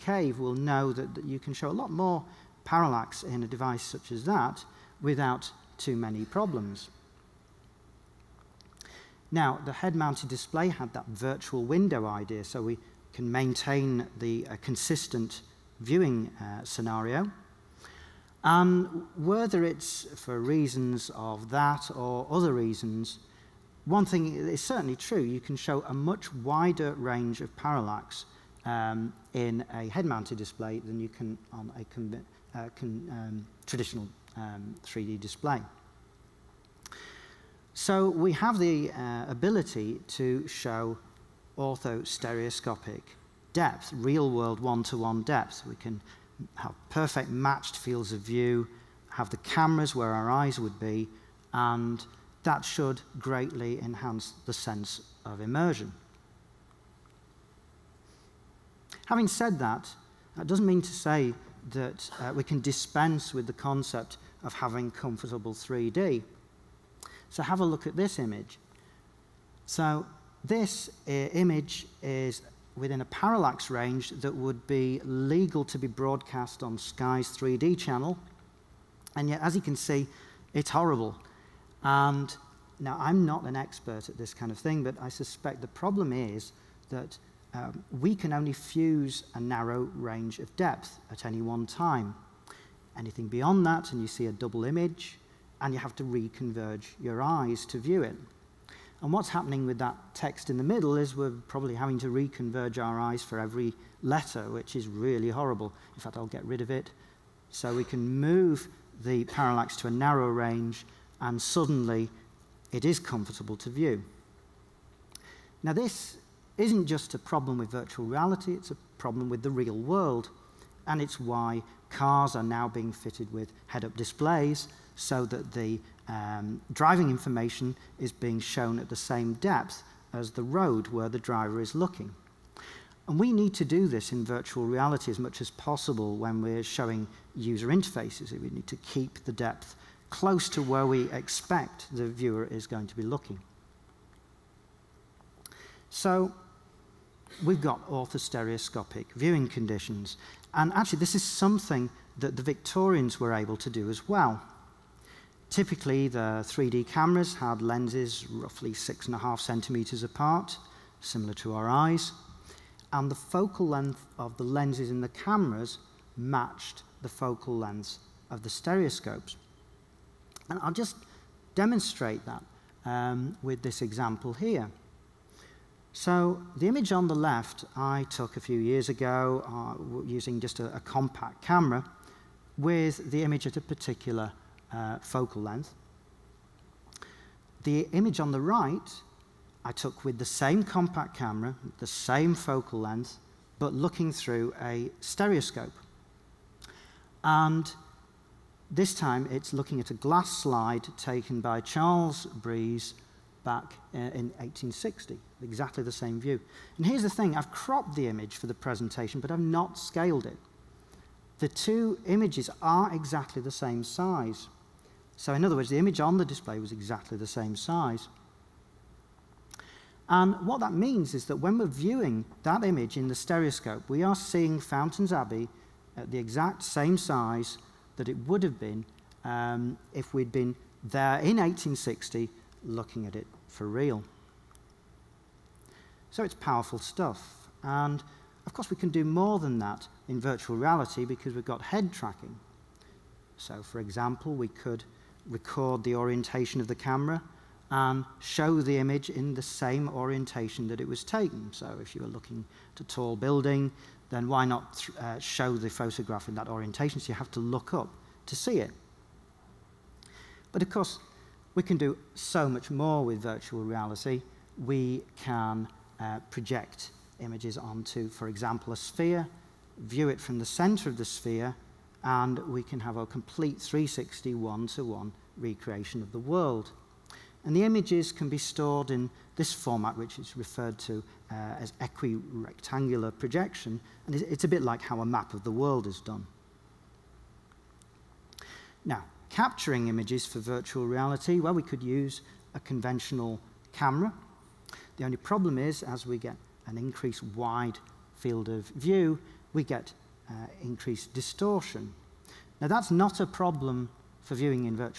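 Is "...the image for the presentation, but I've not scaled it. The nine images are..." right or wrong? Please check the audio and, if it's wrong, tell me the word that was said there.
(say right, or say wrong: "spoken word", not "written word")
wrong: "two", not "nine".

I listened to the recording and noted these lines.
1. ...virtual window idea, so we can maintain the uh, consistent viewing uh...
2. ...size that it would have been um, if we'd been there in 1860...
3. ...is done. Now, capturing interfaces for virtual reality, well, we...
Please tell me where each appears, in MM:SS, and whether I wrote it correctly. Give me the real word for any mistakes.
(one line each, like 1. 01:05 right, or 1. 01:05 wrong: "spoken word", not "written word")
1. 00:11 right
2. 03:46 right
3. 04:45 wrong: "images", not "interfaces".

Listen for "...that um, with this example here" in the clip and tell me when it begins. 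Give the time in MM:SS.
02:52.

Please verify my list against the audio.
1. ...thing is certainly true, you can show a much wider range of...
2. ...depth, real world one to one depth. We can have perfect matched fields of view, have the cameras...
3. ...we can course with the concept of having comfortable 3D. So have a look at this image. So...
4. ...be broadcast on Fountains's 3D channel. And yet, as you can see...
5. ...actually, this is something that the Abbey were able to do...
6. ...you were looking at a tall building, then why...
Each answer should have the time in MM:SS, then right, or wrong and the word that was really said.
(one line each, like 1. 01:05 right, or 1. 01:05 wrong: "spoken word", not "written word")
1. 00:24 right
2. 00:43 right
3. 01:02 wrong: "dispense", not "course"
4. 01:15 wrong: "Sky", not "Fountains"
5. 02:30 wrong: "Victorians", not "Abbey"
6. 04:11 right.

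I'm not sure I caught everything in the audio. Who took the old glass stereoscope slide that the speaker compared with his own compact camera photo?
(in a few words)
Charles Breese.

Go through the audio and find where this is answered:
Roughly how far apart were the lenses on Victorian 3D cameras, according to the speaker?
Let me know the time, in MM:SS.
02:38.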